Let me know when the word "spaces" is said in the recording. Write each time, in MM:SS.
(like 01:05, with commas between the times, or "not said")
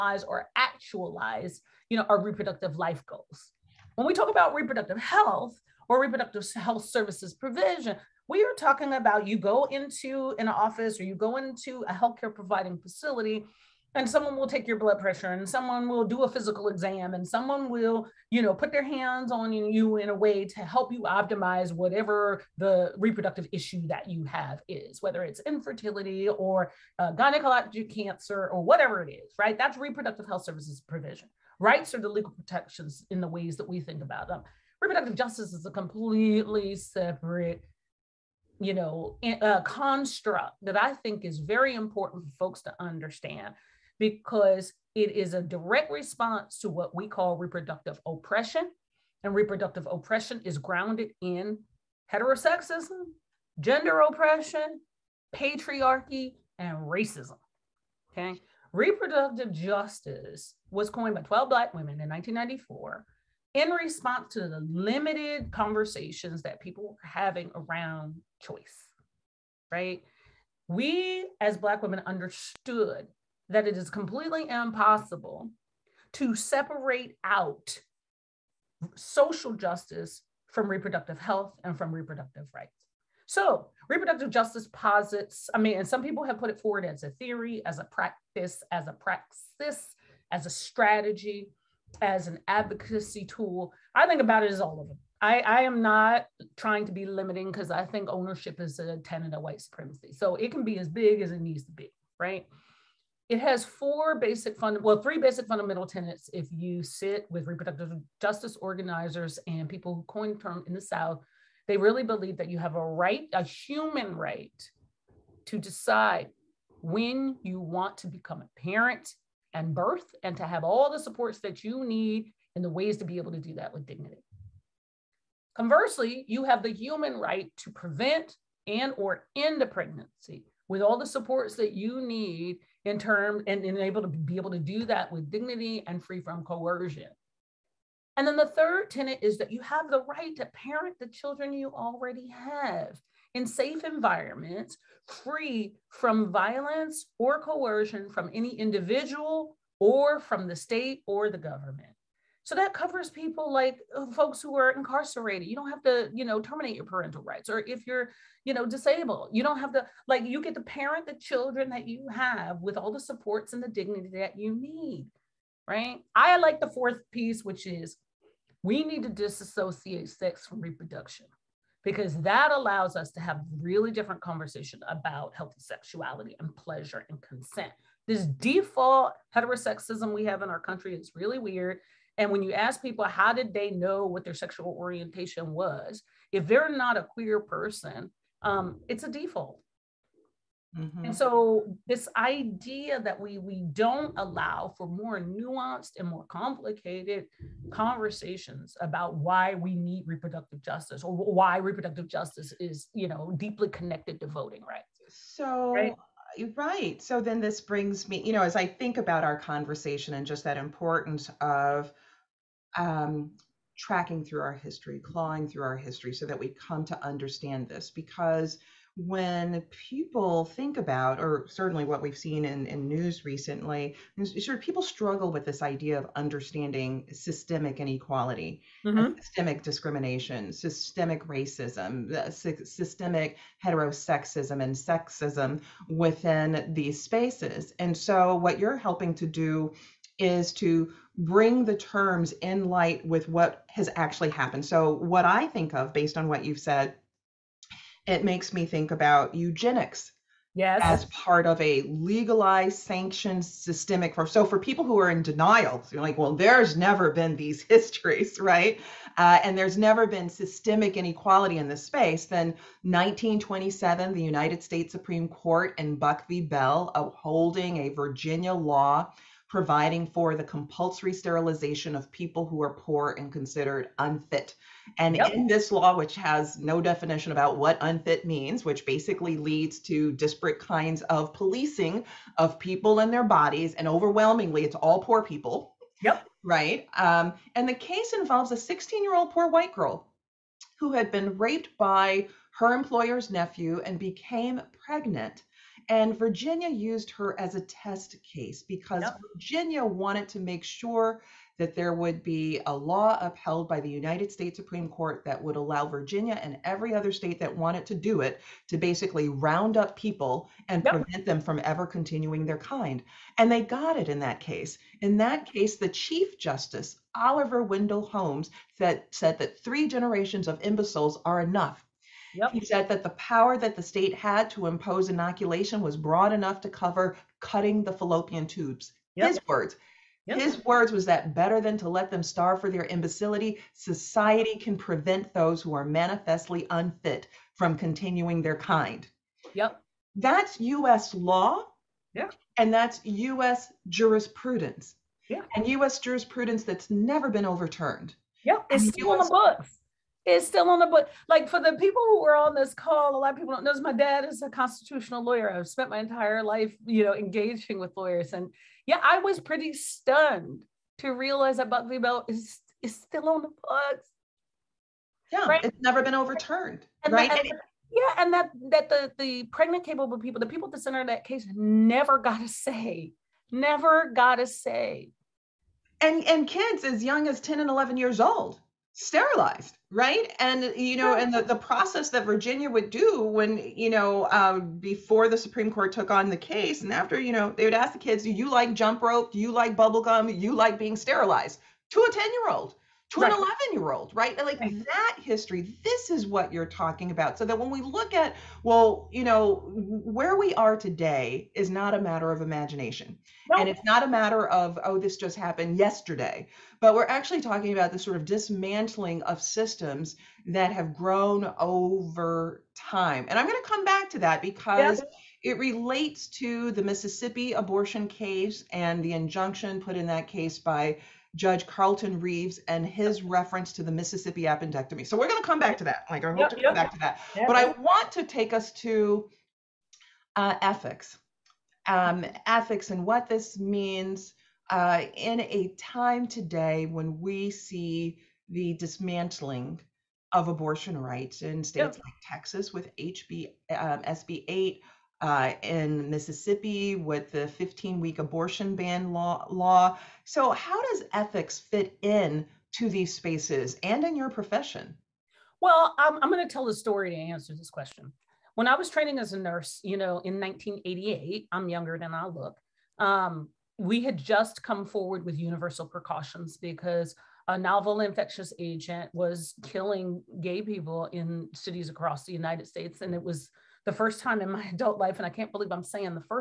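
03:57, 04:21, 07:33.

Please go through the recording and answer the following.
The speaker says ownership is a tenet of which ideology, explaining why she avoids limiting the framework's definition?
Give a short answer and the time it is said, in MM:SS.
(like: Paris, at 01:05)
White supremacy, at 01:39.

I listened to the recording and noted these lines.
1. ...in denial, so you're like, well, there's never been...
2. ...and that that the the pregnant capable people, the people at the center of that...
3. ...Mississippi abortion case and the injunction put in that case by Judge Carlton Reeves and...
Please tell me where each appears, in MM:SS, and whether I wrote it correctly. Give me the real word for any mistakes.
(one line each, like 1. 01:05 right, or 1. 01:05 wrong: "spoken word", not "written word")
1. 04:15 right
2. 06:08 right
3. 06:56 right.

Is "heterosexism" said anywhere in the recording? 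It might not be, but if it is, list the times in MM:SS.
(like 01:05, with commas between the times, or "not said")
00:52, 02:59, 03:53.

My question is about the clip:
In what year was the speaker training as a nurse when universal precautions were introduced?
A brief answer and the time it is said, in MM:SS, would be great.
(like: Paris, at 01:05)
1988, at 07:40.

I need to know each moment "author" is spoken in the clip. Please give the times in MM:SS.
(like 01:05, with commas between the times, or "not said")
not said.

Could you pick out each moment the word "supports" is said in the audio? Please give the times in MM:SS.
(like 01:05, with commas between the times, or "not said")
02:00, 02:11, 02:42.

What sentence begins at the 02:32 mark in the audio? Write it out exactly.
So that covers people like uh, folks who are incarcerated.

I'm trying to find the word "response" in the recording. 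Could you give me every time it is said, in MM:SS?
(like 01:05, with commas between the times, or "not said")
00:45, 01:03.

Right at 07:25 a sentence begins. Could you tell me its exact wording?
Uh, in Mississippi with the 15 week abortion ban law, law.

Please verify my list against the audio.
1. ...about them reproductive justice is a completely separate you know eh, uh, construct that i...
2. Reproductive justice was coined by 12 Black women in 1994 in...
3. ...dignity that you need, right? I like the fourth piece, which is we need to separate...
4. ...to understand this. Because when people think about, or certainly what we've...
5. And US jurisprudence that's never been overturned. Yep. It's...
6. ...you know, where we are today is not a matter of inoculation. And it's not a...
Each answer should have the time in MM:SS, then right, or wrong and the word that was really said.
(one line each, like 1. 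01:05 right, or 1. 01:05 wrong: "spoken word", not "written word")
1. 00:34 right
2. 00:58 right
3. 02:43 wrong: "disassociate", not "separate"
4. 03:36 right
5. 05:45 right
6. 06:39 wrong: "imagination", not "inoculation".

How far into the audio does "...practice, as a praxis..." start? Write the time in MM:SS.
01:27.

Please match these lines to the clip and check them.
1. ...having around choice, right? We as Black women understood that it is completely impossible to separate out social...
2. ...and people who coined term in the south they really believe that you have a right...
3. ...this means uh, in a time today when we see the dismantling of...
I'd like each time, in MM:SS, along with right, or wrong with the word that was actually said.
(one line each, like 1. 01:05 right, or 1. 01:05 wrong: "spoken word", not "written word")
1. 01:07 right
2. 01:49 right
3. 07:13 right.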